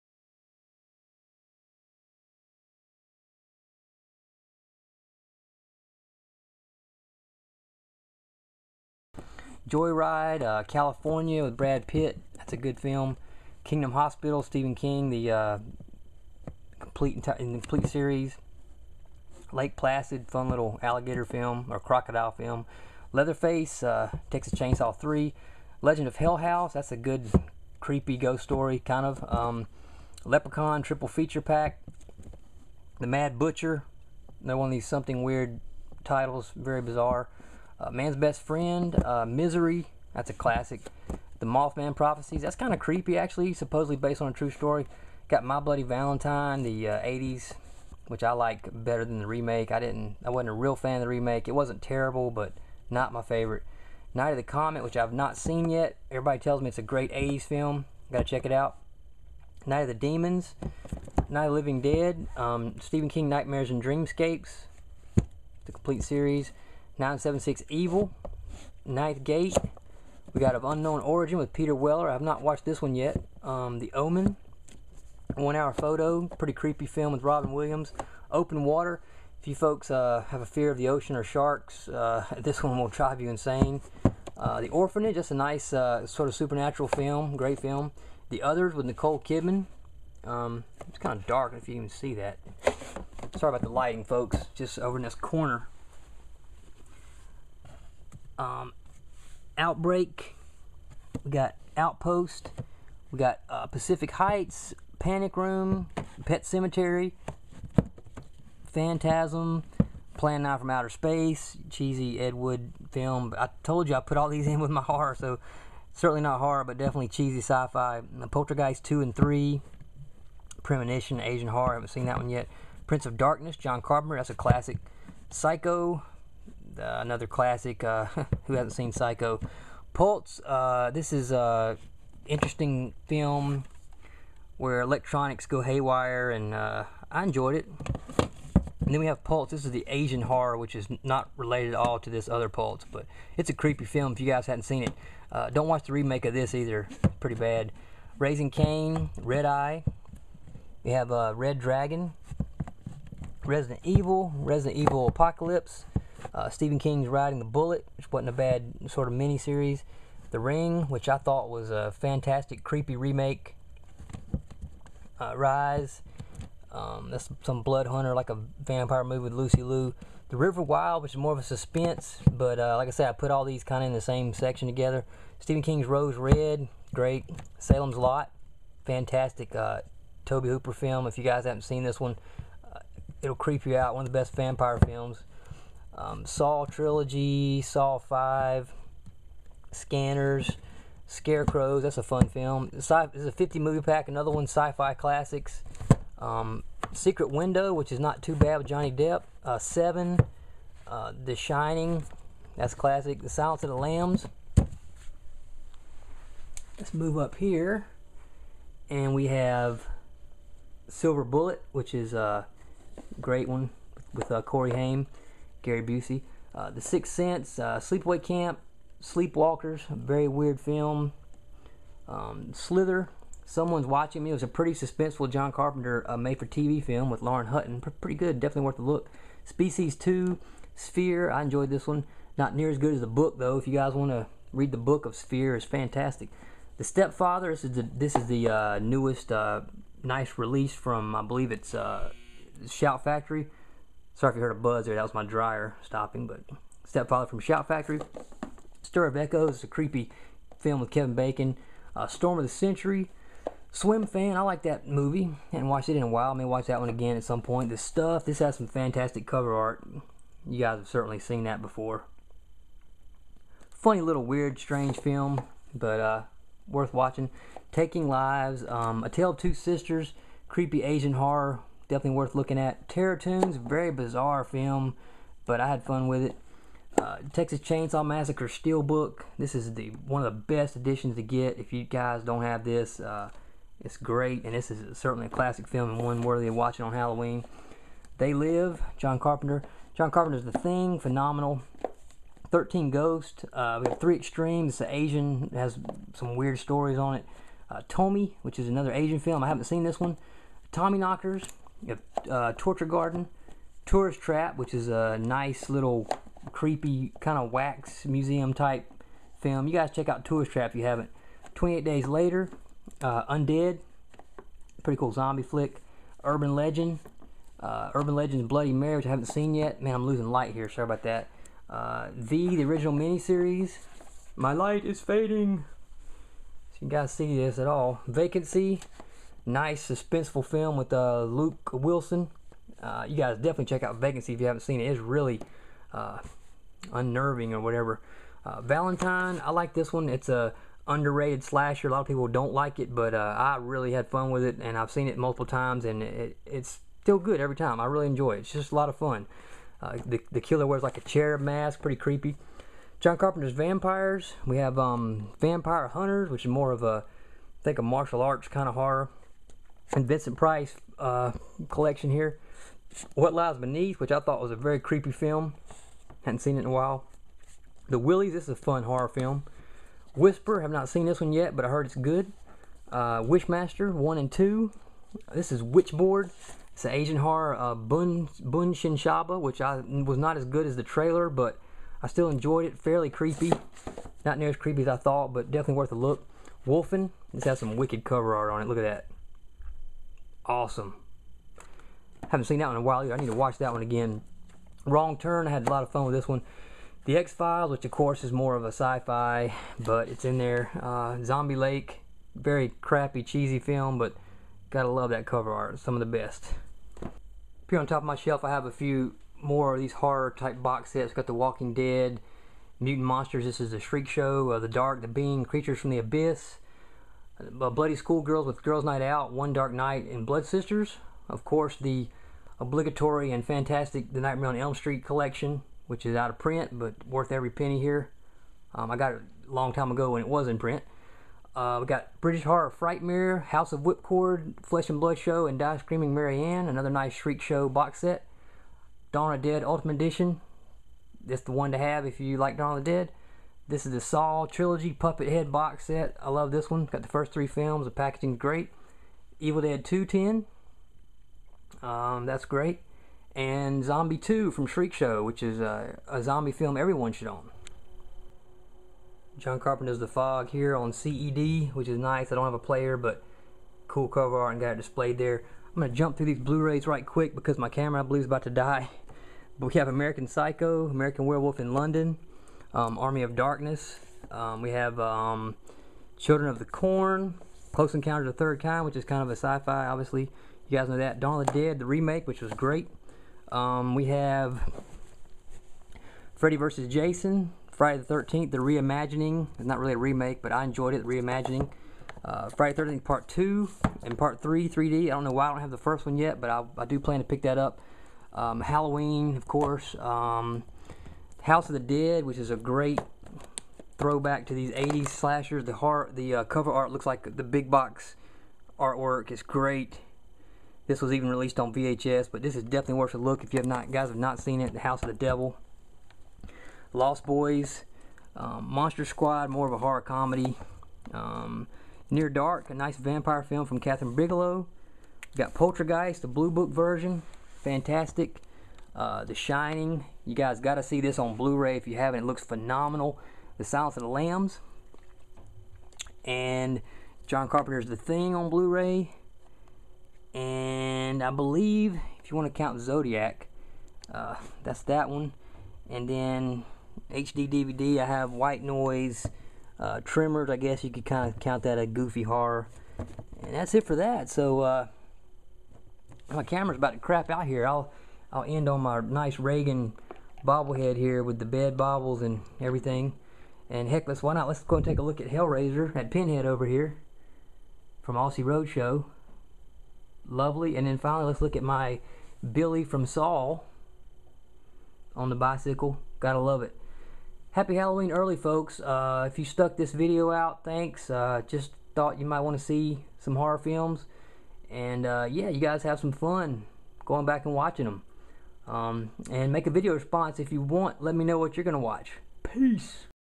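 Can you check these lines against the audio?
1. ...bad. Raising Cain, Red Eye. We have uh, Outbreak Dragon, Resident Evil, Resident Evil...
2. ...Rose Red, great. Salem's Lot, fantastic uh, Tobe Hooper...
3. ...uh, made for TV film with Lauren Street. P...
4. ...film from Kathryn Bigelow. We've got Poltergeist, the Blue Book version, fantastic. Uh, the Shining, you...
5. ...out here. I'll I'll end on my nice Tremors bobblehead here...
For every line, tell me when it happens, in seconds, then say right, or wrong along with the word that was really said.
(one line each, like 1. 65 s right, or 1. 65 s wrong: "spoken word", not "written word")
1. 147 s wrong: "Red", not "Outbreak"
2. 175 s right
3. 226 s wrong: "Hutton", not "Street"
4. 523 s right
5. 557 s wrong: "Regan", not "Tremors".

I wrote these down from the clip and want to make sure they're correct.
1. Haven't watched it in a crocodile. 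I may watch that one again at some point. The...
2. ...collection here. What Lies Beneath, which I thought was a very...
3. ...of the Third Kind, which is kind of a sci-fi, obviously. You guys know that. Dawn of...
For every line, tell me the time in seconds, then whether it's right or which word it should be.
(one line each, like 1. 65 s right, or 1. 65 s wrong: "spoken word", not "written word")
1. 255 s wrong: "while", not "crocodile"
2. 361 s right
3. 478 s right.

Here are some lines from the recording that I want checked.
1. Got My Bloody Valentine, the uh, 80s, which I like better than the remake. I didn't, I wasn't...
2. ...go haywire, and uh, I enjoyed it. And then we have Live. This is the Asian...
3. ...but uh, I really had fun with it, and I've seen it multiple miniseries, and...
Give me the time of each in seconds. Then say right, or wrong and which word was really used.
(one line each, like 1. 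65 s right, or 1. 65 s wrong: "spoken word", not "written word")
1. 45 s right
2. 135 s wrong: "Pulse", not "Live"
3. 342 s wrong: "times", not "miniseries".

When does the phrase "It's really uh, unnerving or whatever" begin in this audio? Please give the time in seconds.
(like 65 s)
334 s.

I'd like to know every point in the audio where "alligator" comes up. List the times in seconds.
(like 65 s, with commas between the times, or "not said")
20 s.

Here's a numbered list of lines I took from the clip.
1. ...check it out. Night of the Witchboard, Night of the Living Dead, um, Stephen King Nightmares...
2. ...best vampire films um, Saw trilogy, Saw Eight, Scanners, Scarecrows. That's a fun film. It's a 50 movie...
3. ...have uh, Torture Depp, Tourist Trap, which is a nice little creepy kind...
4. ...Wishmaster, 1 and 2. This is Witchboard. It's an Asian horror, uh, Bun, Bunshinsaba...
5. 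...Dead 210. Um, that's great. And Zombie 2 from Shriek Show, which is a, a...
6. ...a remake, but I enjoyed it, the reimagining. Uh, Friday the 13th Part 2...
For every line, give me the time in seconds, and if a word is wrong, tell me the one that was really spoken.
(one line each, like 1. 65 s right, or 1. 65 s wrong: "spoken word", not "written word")
1. 58 s wrong: "Demons", not "Witchboard"
2. 184 s wrong: "Five", not "Eight"
3. 301 s wrong: "Garden", not "Depp"
4. 373 s right
5. 449 s right
6. 489 s right.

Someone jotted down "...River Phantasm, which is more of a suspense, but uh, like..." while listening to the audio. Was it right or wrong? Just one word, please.
wrong.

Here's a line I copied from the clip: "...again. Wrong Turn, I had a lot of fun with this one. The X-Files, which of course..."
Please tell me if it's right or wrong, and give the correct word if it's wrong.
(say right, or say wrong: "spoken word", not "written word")
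right.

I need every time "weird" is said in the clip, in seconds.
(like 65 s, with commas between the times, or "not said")
35 s, 220 s, 264 s, 296 s.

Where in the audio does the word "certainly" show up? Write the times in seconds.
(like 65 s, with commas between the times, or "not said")
115 s, 260 s, 284 s.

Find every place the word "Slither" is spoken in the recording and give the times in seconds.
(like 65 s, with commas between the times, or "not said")
222 s.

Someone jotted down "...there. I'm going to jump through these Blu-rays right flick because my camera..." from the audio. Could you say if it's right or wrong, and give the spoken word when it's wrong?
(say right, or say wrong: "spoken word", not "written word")
wrong: "quick", not "flick".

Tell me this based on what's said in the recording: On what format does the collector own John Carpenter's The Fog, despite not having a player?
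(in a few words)
CED.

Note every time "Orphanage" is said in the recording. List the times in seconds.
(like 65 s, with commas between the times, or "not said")
84 s.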